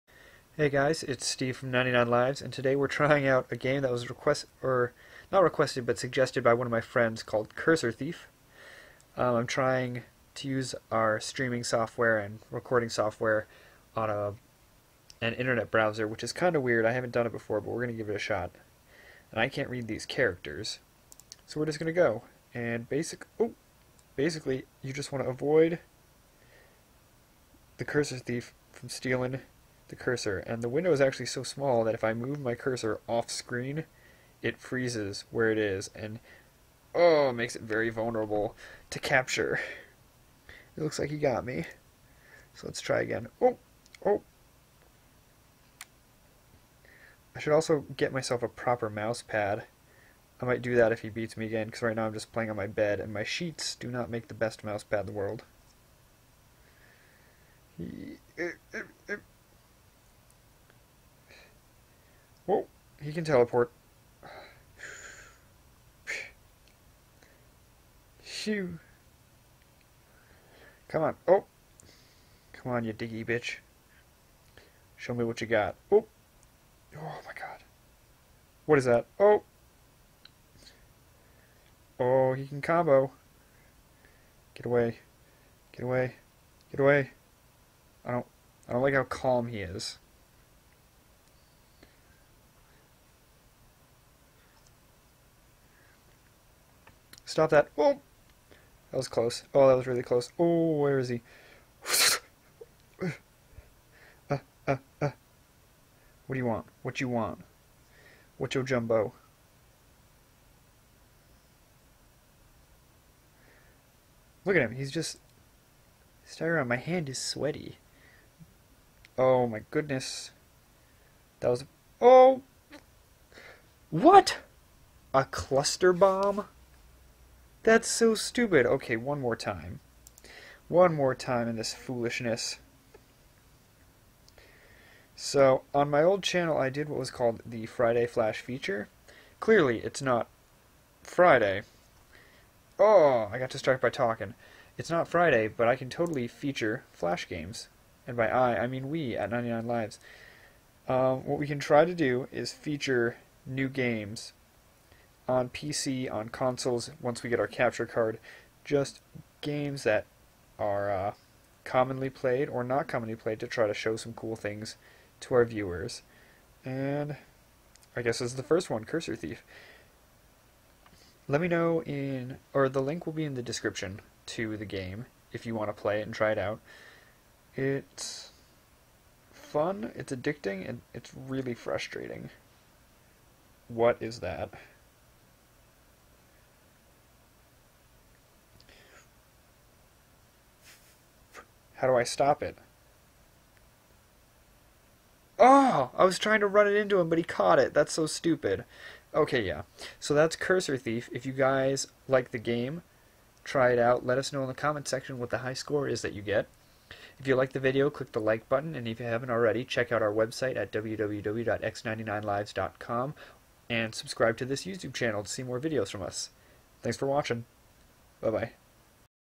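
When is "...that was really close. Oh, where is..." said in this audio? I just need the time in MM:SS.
01:39.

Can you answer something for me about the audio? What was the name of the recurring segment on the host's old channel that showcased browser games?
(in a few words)
Friday Flash feature.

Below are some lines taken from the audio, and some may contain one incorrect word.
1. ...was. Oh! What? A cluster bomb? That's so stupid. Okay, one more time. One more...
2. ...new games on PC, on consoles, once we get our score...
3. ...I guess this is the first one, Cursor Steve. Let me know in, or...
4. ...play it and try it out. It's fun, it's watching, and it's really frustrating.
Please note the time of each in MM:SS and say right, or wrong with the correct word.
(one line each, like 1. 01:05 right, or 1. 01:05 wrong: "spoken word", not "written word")
1. 02:01 right
2. 02:33 wrong: "capture", not "score"
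3. 02:47 wrong: "Thief", not "Steve"
4. 02:55 wrong: "addicting", not "watching".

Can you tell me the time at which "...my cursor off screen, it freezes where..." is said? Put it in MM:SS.
00:32.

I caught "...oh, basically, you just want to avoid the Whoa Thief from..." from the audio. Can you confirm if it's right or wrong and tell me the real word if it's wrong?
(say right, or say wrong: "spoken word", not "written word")
wrong: "Cursor", not "Whoa".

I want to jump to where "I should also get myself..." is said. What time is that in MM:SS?
00:47.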